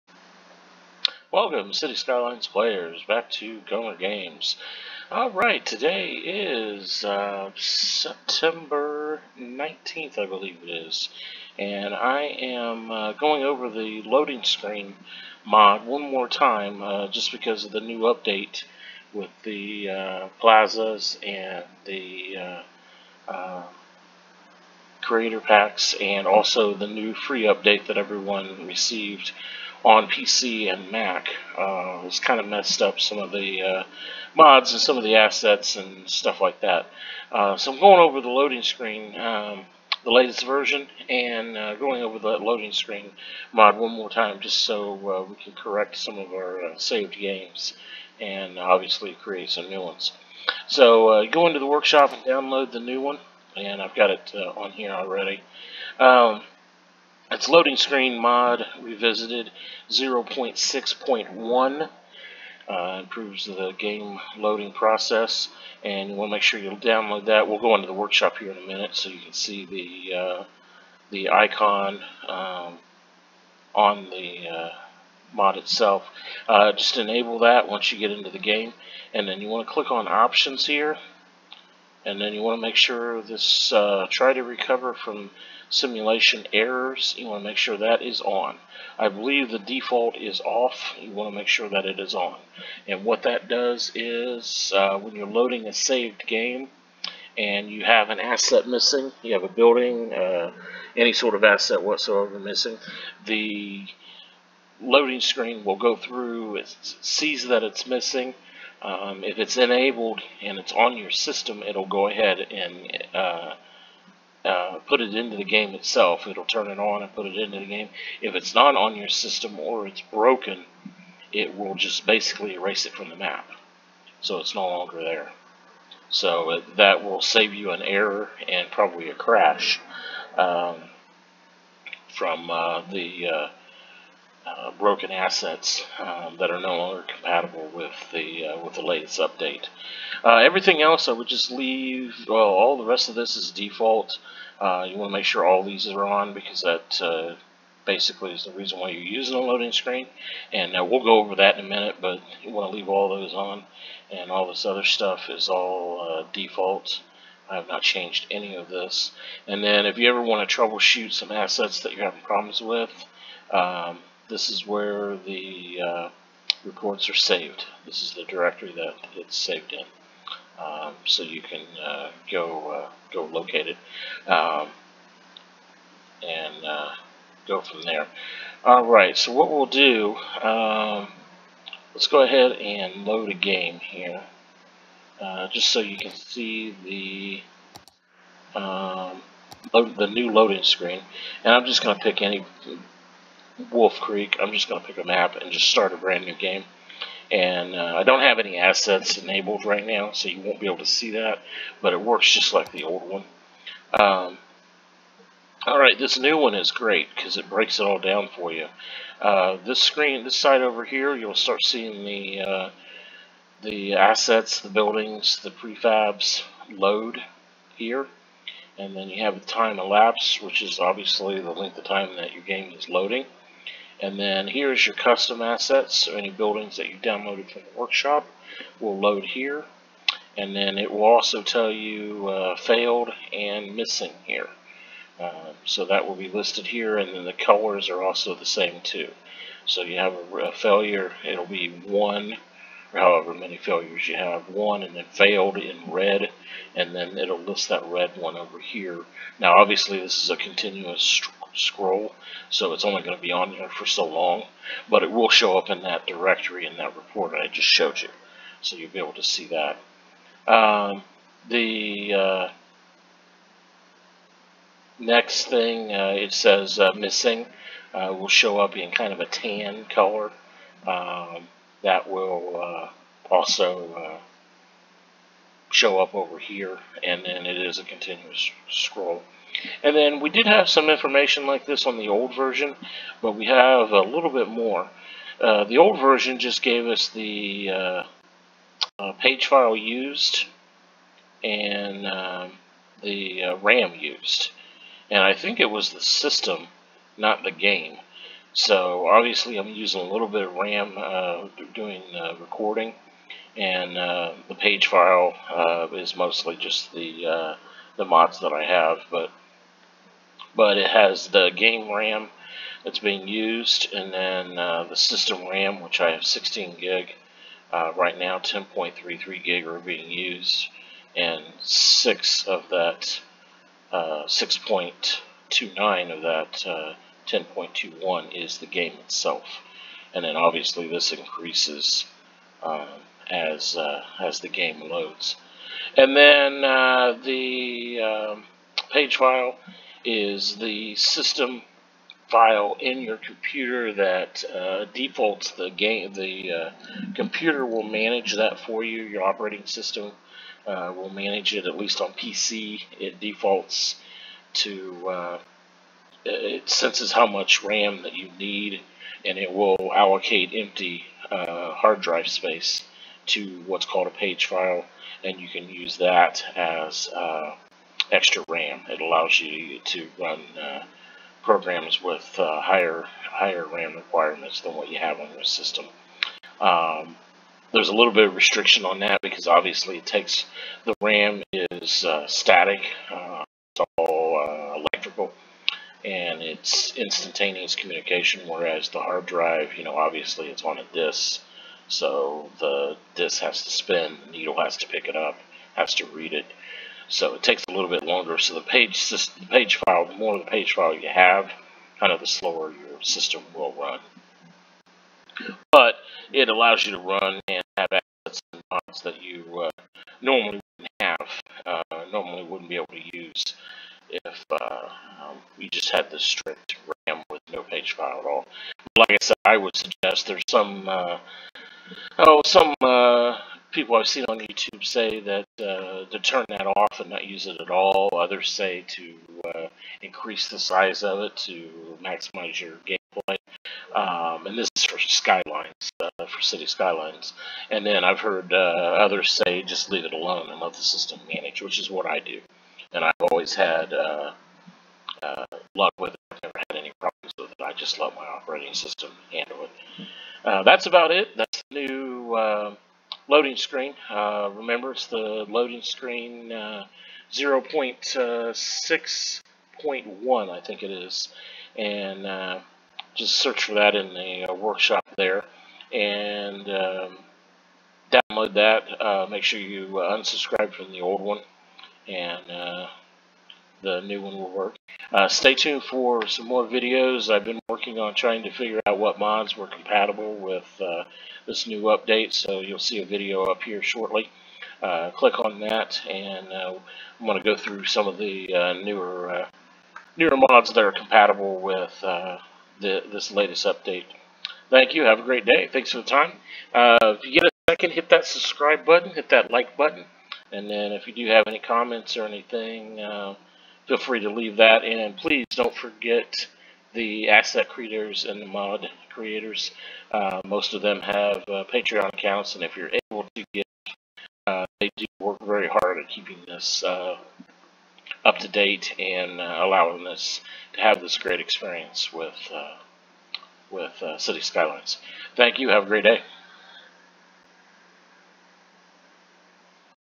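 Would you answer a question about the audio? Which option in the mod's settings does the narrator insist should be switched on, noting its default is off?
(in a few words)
Try to recover from simulation errors.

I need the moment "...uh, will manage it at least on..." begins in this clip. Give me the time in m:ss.
5:50.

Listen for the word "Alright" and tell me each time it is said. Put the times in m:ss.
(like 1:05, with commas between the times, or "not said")
0:05, 3:25.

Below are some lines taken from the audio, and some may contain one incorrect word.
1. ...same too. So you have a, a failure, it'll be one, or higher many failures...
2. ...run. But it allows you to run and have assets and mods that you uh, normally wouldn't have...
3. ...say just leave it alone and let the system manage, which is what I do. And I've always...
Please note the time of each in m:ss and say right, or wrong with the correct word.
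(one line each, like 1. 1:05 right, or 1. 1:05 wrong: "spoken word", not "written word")
1. 3:58 wrong: "however", not "higher"
2. 6:43 right
3. 7:19 right.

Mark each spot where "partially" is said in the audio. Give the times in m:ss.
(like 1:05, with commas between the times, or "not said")
not said.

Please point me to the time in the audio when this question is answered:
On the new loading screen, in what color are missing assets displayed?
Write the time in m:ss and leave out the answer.
4:29.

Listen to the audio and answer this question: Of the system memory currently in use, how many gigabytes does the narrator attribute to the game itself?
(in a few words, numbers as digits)
6.29.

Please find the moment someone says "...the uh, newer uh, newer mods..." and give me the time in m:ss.
8:08.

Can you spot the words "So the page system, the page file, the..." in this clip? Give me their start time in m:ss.
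6:38.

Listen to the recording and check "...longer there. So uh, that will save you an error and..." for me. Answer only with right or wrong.
right.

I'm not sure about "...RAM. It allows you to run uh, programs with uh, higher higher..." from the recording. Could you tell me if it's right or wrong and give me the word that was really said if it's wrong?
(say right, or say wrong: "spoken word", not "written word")
right.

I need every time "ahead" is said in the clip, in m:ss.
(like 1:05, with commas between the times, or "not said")
1:52, 3:02.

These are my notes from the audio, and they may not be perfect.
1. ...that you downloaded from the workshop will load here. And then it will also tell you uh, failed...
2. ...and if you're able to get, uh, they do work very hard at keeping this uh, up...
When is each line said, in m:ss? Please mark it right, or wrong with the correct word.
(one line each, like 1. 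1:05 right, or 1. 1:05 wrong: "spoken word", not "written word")
1. 3:46 right
2. 8:32 right.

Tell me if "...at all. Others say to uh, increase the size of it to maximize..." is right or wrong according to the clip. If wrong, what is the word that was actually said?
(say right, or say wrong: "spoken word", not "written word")
right.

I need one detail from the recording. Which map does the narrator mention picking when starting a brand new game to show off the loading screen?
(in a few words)
Wolf Creek.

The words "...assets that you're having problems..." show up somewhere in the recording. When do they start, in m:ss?
2:41.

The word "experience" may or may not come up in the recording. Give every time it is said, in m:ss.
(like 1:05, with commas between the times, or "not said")
8:41.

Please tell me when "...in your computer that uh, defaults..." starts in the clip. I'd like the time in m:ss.
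5:42.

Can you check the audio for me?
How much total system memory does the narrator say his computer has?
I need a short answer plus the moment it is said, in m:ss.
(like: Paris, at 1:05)
16 GB, at 5:16.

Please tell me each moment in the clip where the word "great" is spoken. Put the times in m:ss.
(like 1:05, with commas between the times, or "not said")
3:26, 8:15, 8:41, 8:45.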